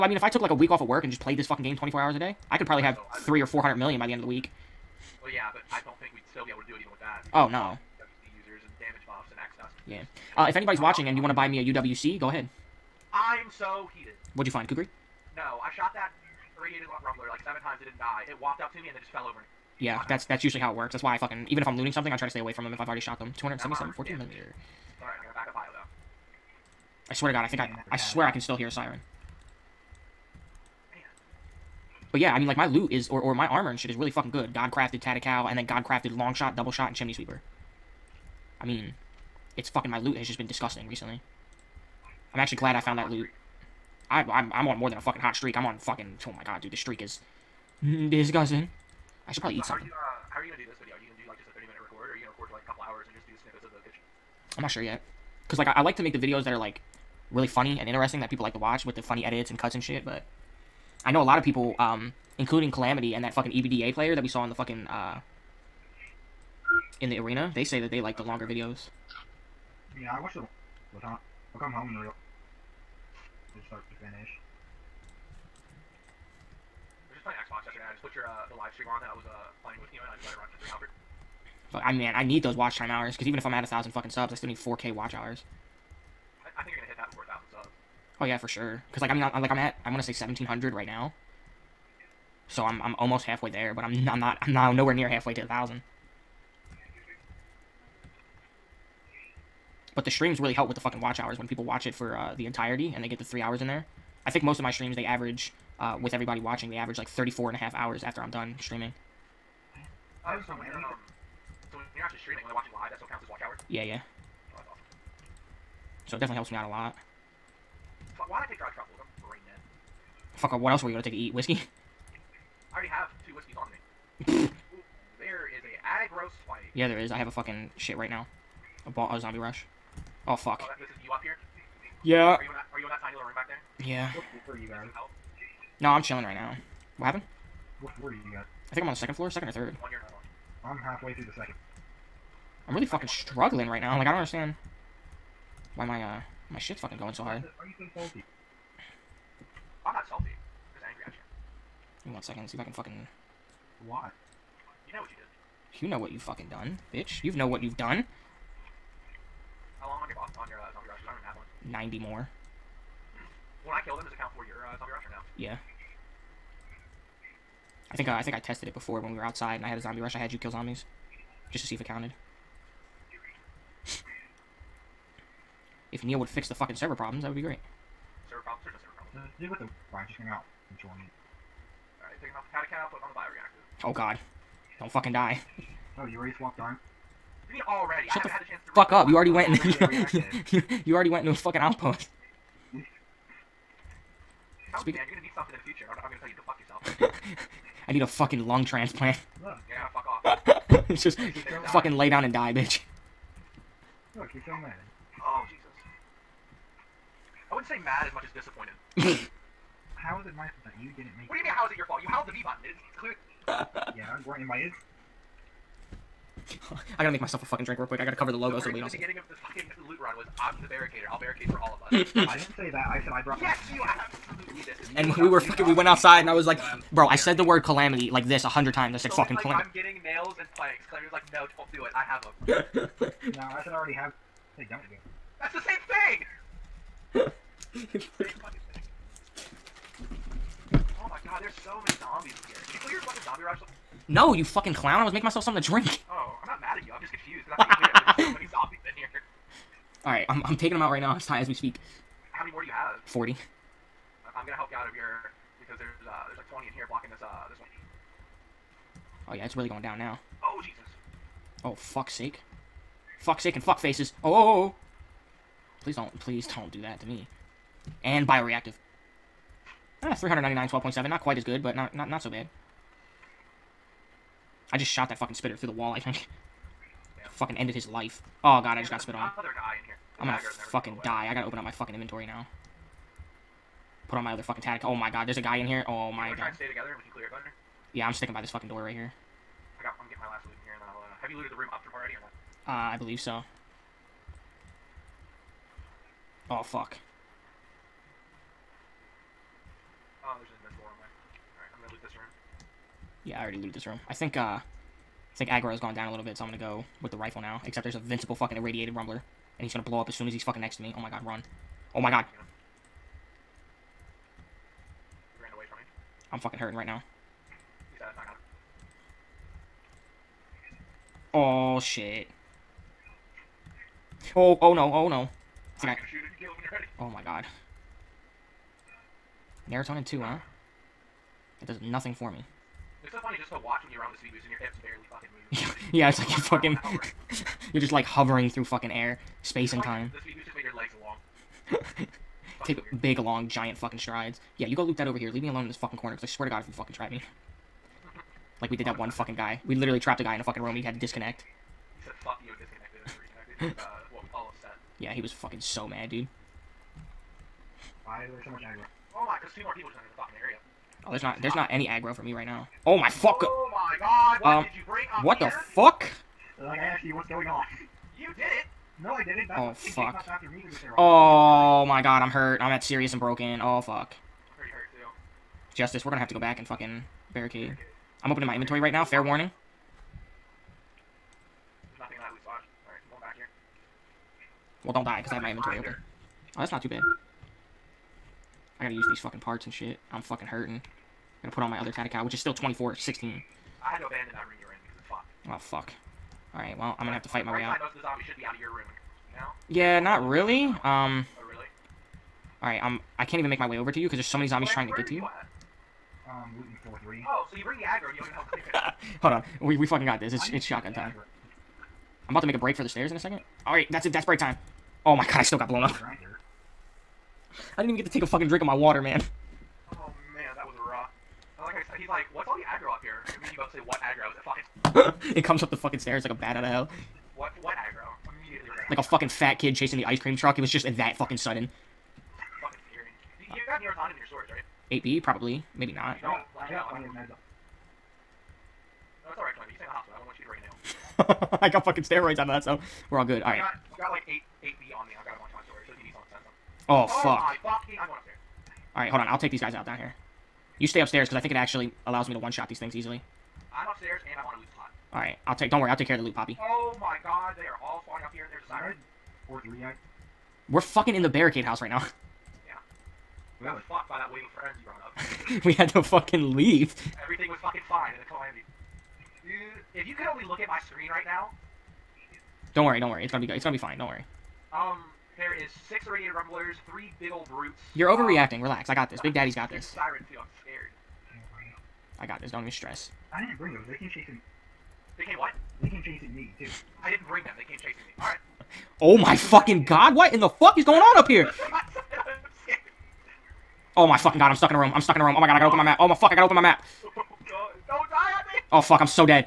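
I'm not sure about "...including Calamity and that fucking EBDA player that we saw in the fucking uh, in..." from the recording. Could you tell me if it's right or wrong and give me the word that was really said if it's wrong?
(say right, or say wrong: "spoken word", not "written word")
right.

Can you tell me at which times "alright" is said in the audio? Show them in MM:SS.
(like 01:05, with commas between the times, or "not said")
03:01, 06:36, 06:42, 07:23, 07:28, 07:35.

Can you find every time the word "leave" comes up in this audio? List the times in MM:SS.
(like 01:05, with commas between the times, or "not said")
05:45, 07:46.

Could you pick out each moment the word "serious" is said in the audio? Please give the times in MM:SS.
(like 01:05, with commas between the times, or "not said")
06:12.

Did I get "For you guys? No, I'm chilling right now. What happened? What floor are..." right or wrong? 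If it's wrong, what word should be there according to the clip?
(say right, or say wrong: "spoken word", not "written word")
right.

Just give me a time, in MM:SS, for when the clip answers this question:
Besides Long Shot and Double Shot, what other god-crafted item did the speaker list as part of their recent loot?
00:36.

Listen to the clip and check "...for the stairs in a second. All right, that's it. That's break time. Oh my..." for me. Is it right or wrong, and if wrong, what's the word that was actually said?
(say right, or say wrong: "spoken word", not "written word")
right.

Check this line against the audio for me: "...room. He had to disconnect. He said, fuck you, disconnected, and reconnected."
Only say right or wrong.
right.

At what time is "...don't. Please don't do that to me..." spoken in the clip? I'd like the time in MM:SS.
04:25.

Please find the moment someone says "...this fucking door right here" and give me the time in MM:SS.
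04:48.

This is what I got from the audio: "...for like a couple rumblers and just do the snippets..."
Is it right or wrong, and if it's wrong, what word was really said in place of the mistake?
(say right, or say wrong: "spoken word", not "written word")
wrong: "hours", not "rumblers".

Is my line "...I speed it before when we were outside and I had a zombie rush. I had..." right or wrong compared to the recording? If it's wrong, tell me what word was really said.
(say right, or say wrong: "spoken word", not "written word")
wrong: "tested", not "speed".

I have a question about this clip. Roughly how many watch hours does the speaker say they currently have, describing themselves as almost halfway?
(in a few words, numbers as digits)
1700.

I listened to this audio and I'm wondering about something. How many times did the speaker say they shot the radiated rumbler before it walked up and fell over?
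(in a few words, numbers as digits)
7.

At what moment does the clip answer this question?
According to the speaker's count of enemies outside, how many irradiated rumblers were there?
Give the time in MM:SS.
07:55.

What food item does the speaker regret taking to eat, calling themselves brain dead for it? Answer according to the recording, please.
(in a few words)
dry truffles.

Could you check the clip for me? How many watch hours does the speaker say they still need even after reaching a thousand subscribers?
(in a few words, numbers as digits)
4K.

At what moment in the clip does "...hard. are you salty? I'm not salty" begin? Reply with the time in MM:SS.
02:27.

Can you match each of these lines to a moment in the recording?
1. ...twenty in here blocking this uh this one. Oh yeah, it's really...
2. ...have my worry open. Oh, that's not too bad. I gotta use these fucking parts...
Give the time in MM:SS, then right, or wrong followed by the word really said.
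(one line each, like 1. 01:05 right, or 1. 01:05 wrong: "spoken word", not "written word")
1. 04:16 right
2. 06:25 wrong: "inventory", not "worry".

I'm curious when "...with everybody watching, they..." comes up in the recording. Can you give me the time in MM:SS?
01:46.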